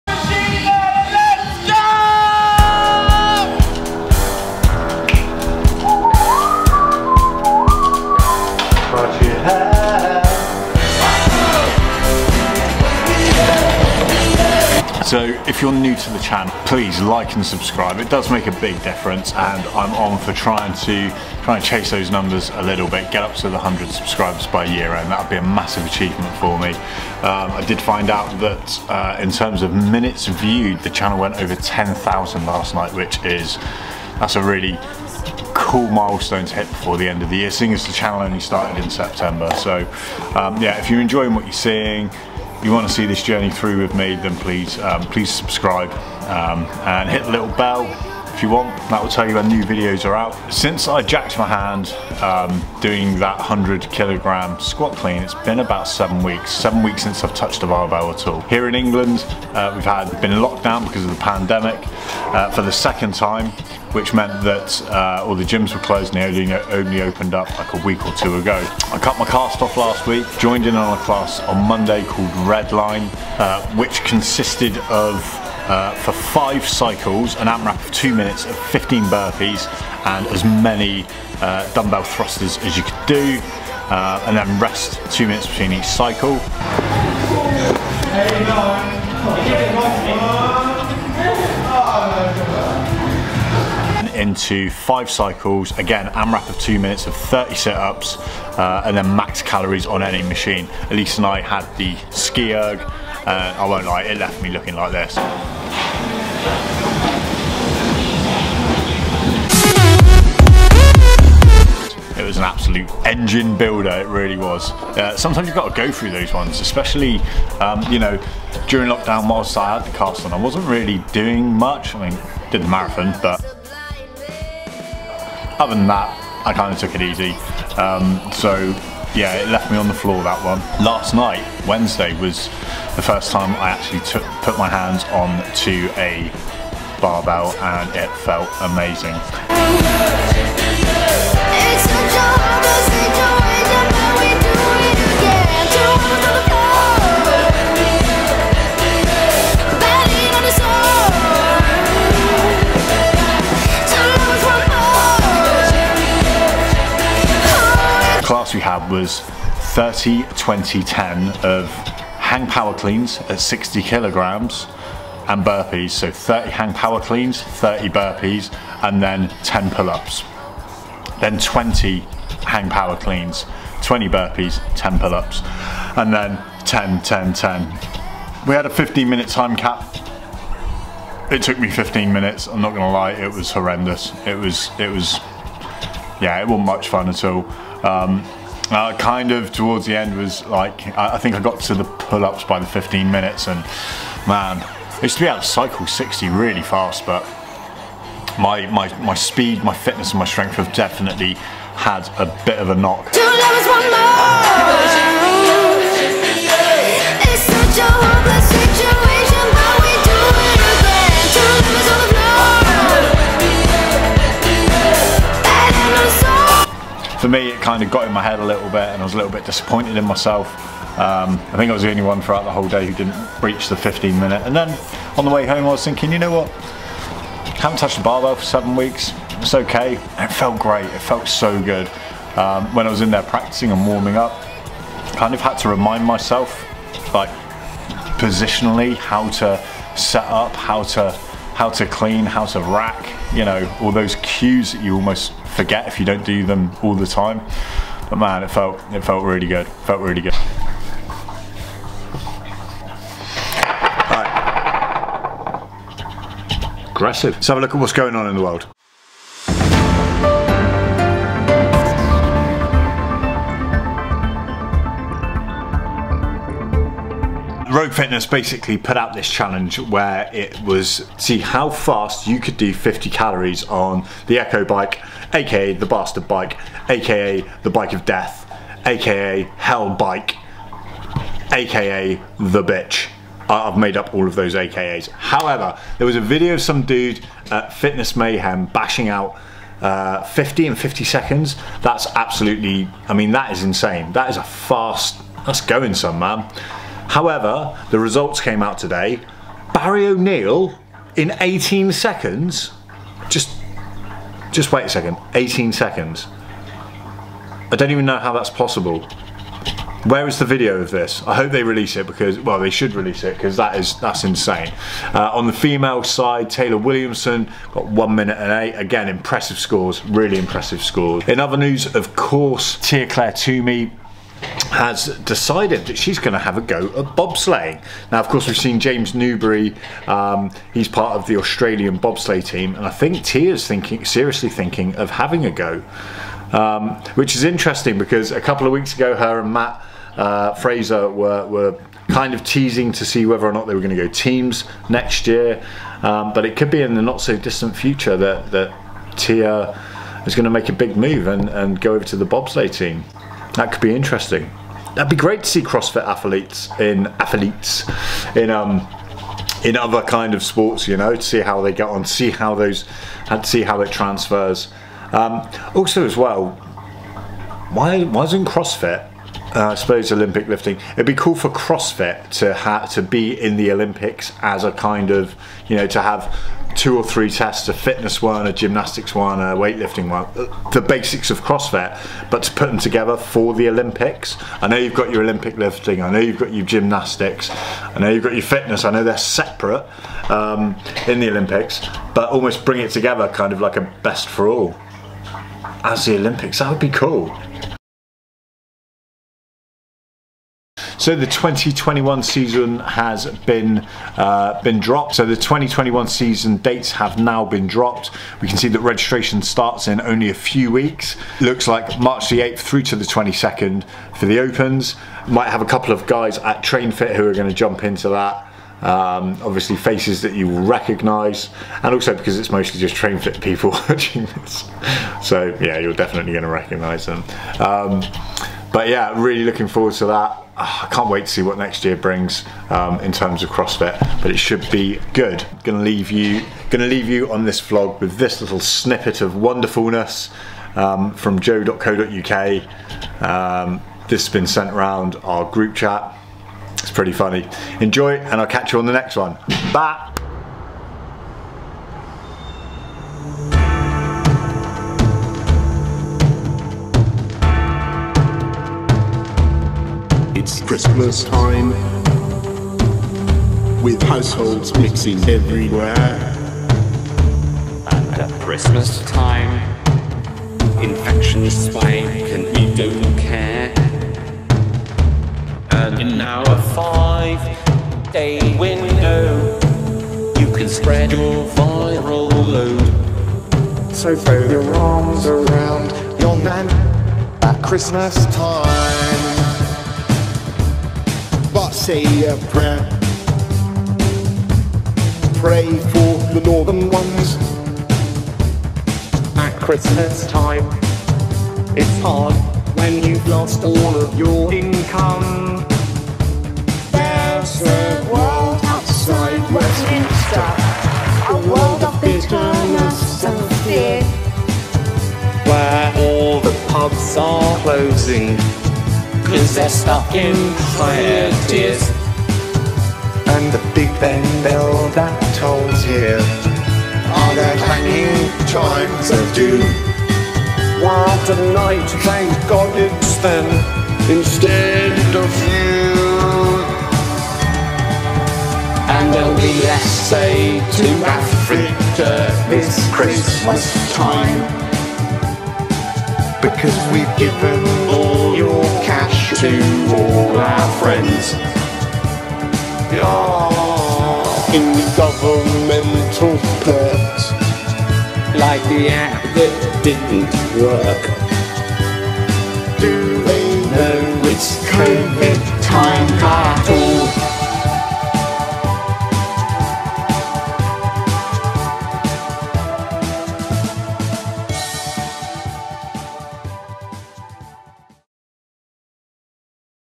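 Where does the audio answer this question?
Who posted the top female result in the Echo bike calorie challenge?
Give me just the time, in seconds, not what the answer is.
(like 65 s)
316 s.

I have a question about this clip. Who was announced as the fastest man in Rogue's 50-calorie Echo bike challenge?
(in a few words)
Barry O'Neill.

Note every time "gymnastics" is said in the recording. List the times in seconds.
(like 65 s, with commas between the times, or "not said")
378 s, 386 s.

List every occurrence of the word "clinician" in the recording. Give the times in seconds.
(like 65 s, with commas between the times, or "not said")
not said.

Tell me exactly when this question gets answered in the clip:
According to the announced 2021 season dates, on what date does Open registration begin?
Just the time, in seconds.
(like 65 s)
411 s.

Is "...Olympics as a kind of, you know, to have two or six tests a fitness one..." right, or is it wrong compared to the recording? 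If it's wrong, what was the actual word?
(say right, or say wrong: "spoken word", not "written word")
wrong: "three", not "six".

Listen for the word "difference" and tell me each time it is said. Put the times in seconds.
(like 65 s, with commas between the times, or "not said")
18 s.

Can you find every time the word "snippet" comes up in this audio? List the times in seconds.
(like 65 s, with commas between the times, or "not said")
438 s.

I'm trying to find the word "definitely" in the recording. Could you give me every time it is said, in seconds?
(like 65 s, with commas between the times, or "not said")
200 s, 425 s.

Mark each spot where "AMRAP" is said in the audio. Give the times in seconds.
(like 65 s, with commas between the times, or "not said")
77 s, 96 s.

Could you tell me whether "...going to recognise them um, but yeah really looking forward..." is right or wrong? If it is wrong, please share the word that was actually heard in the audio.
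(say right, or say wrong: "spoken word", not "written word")
right.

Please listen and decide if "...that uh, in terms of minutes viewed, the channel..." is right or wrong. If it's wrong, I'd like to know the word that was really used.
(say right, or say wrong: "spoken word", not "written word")
right.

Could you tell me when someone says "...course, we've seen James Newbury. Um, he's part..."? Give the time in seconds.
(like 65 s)
328 s.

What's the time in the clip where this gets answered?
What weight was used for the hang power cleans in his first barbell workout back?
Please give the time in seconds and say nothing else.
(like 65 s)
163 s.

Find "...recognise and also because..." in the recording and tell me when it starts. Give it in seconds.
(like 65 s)
420 s.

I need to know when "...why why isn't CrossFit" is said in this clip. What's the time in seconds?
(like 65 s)
367 s.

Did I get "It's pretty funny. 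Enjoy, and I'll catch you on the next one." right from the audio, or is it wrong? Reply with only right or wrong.
right.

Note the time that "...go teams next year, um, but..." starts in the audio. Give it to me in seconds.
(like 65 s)
344 s.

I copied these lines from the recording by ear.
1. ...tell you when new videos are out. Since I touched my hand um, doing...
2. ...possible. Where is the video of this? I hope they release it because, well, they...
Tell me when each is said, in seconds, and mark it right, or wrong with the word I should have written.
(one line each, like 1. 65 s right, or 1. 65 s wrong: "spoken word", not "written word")
1. 49 s wrong: "jacked", not "touched"
2. 308 s right.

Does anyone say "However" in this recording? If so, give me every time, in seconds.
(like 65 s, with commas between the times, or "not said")
285 s, 297 s.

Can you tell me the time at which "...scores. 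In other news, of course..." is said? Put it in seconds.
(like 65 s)
320 s.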